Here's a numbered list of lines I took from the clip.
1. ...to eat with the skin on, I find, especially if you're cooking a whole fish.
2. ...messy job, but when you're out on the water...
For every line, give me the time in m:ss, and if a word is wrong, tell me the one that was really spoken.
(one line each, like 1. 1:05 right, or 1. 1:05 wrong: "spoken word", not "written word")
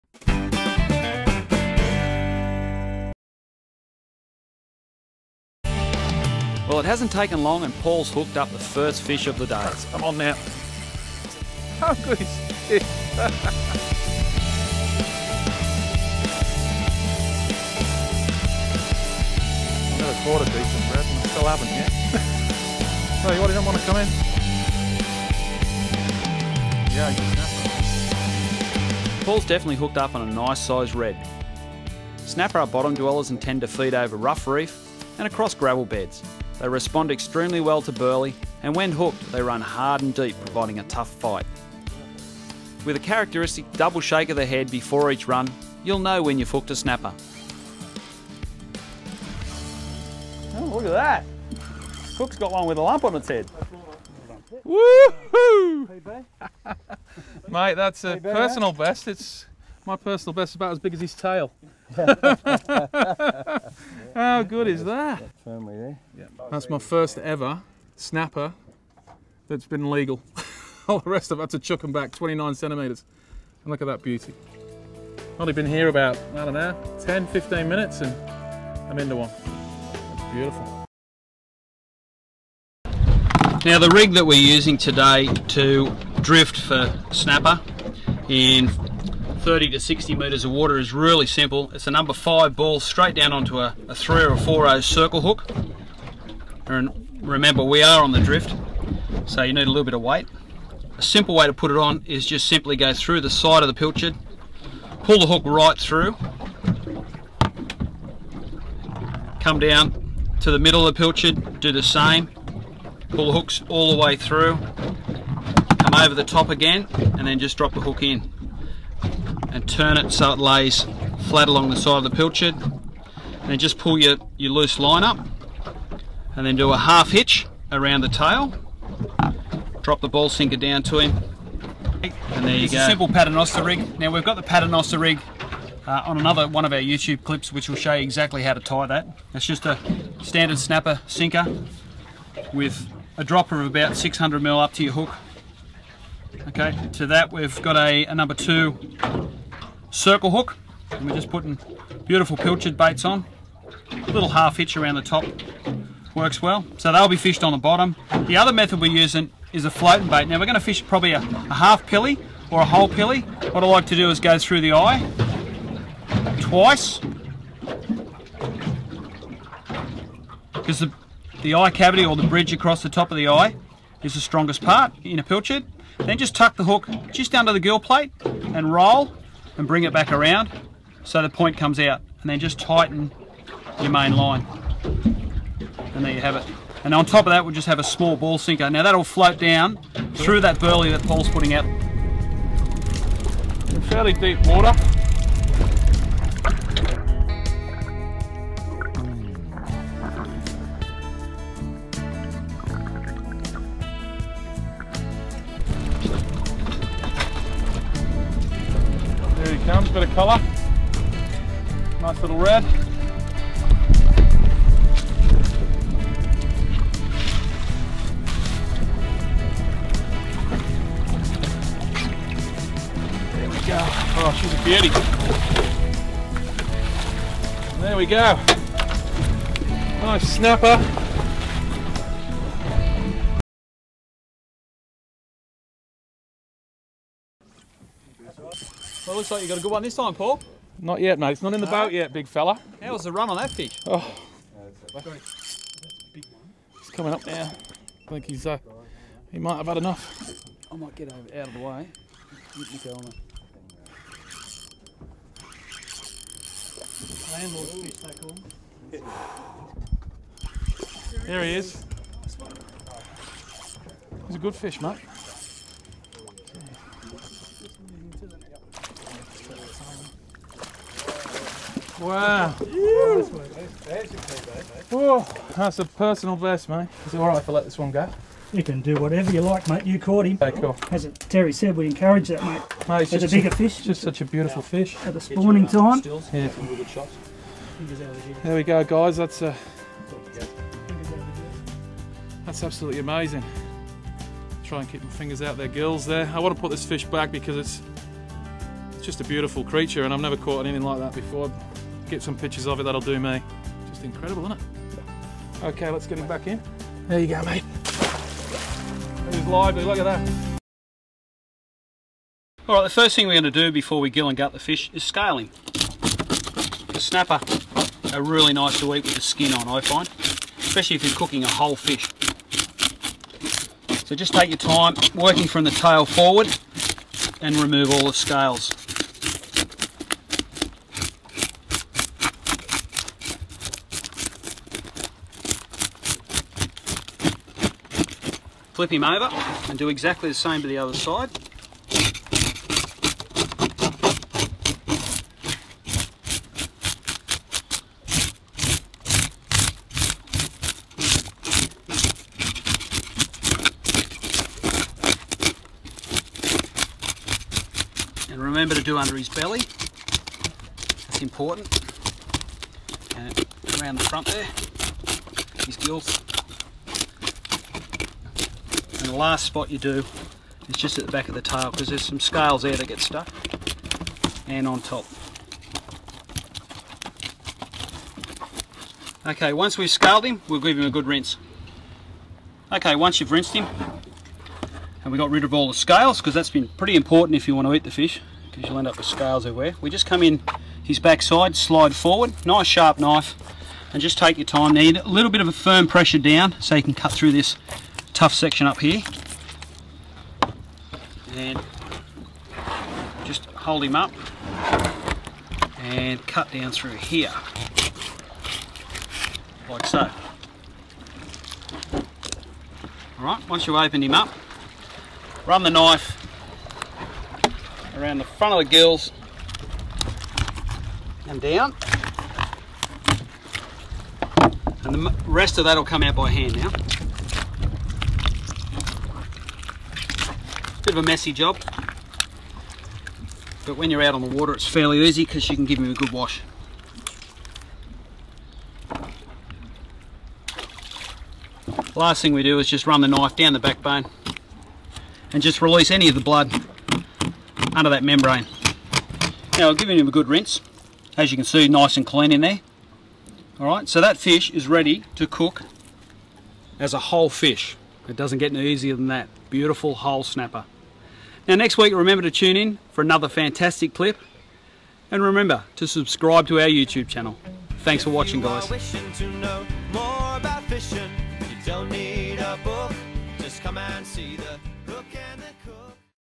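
1. 5:18 right
2. 7:11 right.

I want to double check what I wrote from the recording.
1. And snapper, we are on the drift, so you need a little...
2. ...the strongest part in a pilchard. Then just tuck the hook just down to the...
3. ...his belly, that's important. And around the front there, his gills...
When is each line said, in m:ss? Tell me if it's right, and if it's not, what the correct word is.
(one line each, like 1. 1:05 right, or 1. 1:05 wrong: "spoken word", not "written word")
1. 1:36 wrong: "remember", not "snapper"
2. 2:54 right
3. 5:59 right.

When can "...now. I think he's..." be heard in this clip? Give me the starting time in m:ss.
4:07.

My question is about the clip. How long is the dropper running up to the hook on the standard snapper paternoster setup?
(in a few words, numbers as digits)
600 mil.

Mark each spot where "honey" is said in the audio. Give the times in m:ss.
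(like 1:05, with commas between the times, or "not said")
not said.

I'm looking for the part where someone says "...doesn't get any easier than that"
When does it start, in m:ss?
7:38.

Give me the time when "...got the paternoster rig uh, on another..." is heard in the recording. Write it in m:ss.
2:14.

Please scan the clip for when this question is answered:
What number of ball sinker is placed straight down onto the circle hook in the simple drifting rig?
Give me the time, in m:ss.
1:31.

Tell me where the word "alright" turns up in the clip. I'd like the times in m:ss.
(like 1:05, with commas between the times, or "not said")
4:37, 6:53, 7:33.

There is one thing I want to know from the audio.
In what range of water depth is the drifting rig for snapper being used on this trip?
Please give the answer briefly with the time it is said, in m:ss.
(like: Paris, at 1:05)
30 to 60 meters, at 1:29.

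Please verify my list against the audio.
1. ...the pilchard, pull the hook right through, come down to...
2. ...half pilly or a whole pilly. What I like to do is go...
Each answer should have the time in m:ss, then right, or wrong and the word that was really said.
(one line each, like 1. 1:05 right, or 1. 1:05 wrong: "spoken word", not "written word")
1. 1:43 right
2. 2:41 right.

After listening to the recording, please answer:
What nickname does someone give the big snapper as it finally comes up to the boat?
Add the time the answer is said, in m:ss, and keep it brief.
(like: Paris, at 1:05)
Landlord fish, at 4:17.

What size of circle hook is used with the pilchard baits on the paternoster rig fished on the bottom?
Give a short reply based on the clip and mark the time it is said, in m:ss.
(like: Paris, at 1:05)
number 2, at 2:28.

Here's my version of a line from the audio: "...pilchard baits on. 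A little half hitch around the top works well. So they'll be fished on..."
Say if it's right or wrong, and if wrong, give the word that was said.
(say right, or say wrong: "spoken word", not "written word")
right.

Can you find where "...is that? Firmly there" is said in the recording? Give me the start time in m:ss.
1:04.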